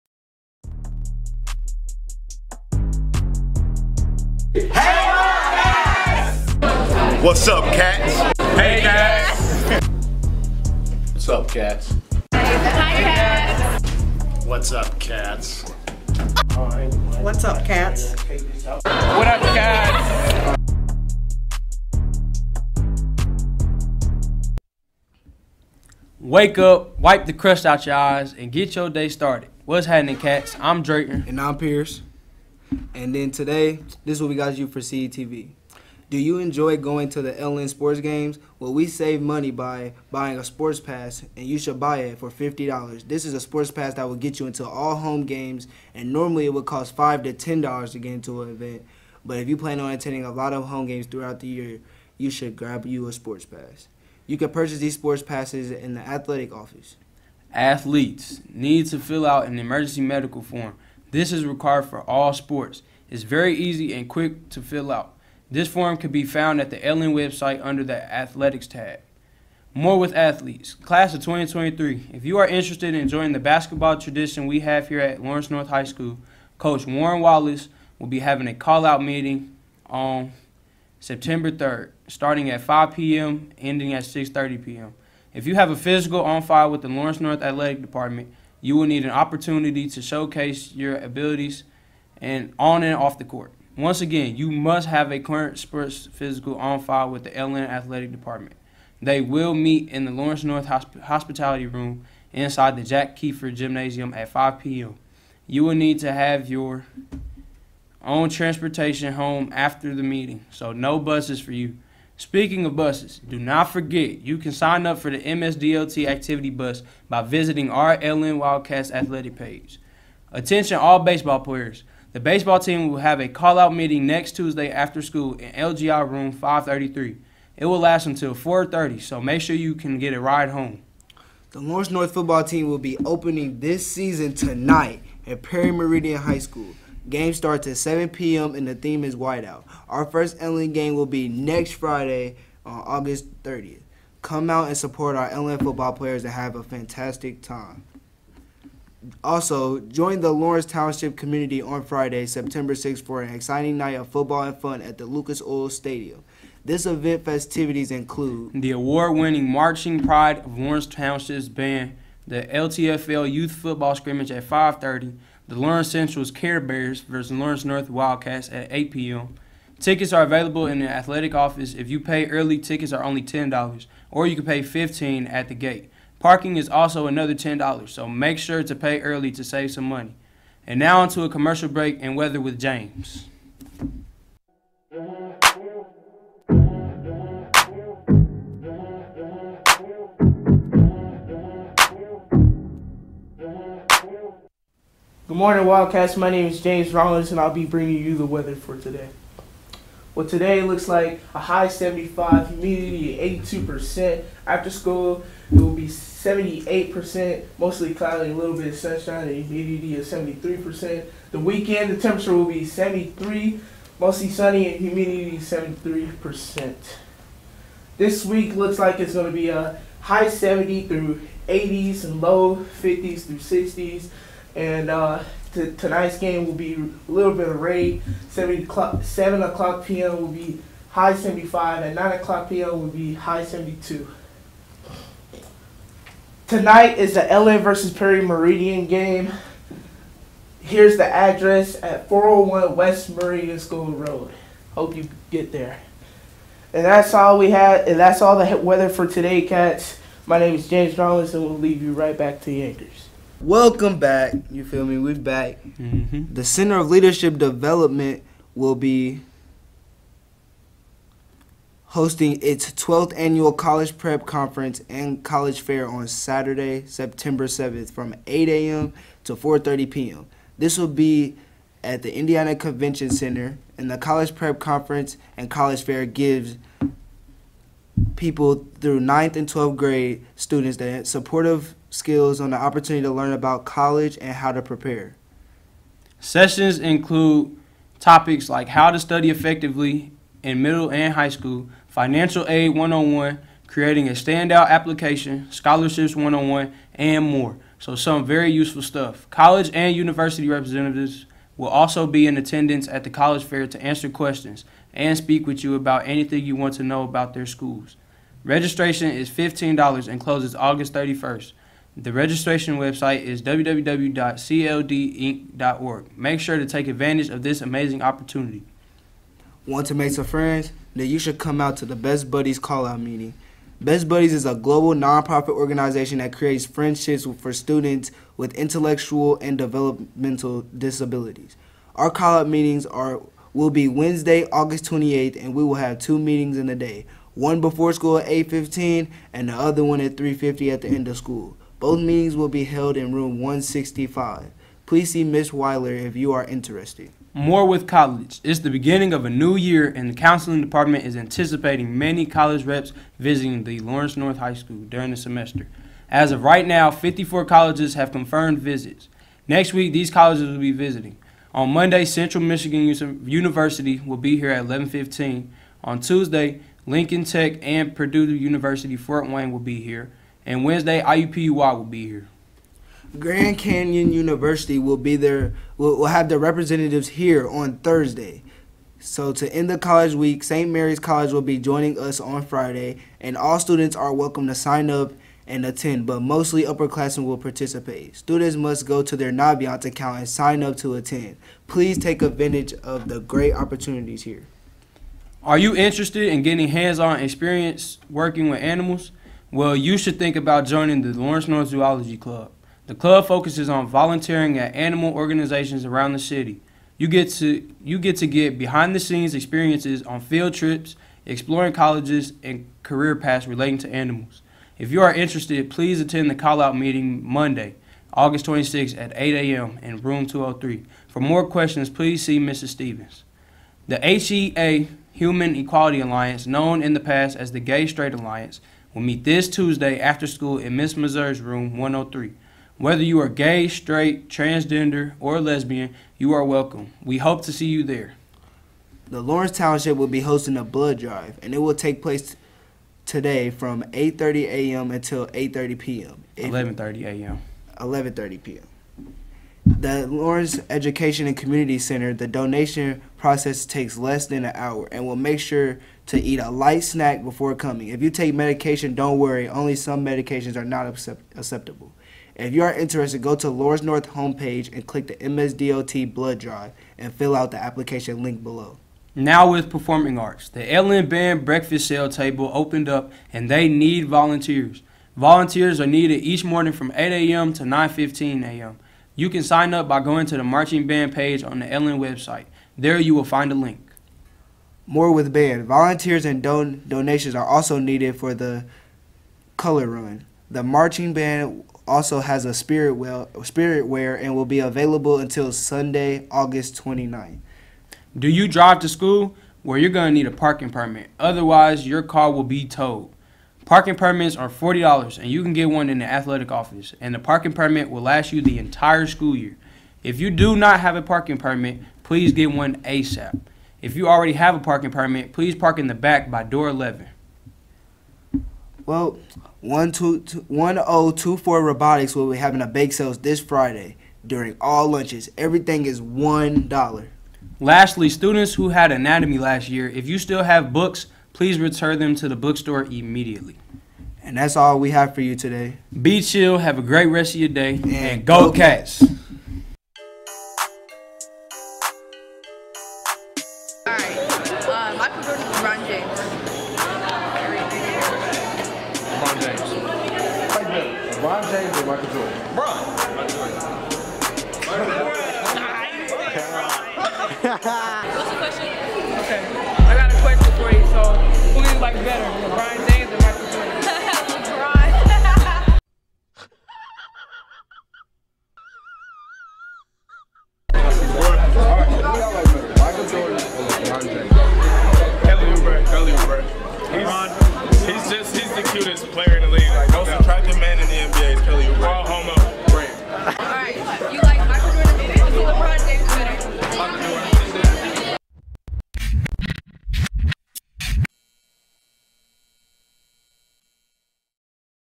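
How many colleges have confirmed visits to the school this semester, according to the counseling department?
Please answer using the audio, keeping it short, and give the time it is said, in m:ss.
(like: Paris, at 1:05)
54, at 5:56.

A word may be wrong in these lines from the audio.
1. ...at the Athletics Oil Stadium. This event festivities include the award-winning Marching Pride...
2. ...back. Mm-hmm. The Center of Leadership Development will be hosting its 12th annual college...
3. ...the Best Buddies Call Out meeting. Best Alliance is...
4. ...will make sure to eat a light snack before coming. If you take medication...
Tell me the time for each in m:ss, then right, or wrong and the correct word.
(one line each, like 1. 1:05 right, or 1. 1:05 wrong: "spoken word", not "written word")
1. 2:34 wrong: "Lucas", not "Athletics"
2. 4:15 right
3. 5:21 wrong: "Buddies", not "Alliance"
4. 7:35 right.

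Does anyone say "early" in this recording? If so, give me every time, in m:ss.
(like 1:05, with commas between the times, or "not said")
2:52, 2:59.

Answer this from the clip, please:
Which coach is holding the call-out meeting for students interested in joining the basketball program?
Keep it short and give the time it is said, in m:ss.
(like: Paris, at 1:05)
Warren Wallace, at 1:16.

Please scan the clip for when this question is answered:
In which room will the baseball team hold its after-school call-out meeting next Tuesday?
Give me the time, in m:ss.
2:05.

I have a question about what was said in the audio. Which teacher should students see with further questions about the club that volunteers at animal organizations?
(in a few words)
Mrs. Stevens.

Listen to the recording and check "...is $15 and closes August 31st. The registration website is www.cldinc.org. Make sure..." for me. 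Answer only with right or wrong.
right.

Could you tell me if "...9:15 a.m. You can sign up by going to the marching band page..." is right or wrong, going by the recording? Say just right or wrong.
right.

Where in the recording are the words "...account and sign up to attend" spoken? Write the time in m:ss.
6:29.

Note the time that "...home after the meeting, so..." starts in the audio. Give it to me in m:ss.
1:49.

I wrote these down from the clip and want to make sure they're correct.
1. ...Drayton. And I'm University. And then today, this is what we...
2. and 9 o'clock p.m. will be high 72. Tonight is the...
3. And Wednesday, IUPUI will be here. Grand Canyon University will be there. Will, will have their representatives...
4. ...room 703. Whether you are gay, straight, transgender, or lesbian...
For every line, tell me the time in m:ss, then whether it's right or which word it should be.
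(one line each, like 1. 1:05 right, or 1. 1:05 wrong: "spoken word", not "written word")
1. 0:30 wrong: "Pierce", not "University"
2. 3:51 right
3. 6:10 right
4. 7:11 wrong: "103", not "703".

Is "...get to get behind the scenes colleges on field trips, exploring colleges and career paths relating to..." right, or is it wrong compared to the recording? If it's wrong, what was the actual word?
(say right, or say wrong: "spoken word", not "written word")
wrong: "experiences", not "colleges".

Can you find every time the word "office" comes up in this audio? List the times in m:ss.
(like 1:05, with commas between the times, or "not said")
0:56, 2:51, 8:26.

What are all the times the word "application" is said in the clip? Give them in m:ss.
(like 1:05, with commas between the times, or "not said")
4:54, 7:47.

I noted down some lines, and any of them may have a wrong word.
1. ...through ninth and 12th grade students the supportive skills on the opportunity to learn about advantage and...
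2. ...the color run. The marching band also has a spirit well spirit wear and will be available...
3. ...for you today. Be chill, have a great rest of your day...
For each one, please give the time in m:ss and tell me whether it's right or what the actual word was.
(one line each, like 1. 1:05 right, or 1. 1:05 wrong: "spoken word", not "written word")
1. 4:38 wrong: "college", not "advantage"
2. 8:08 right
3. 8:55 right.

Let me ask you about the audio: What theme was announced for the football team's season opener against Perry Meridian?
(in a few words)
Whiteout.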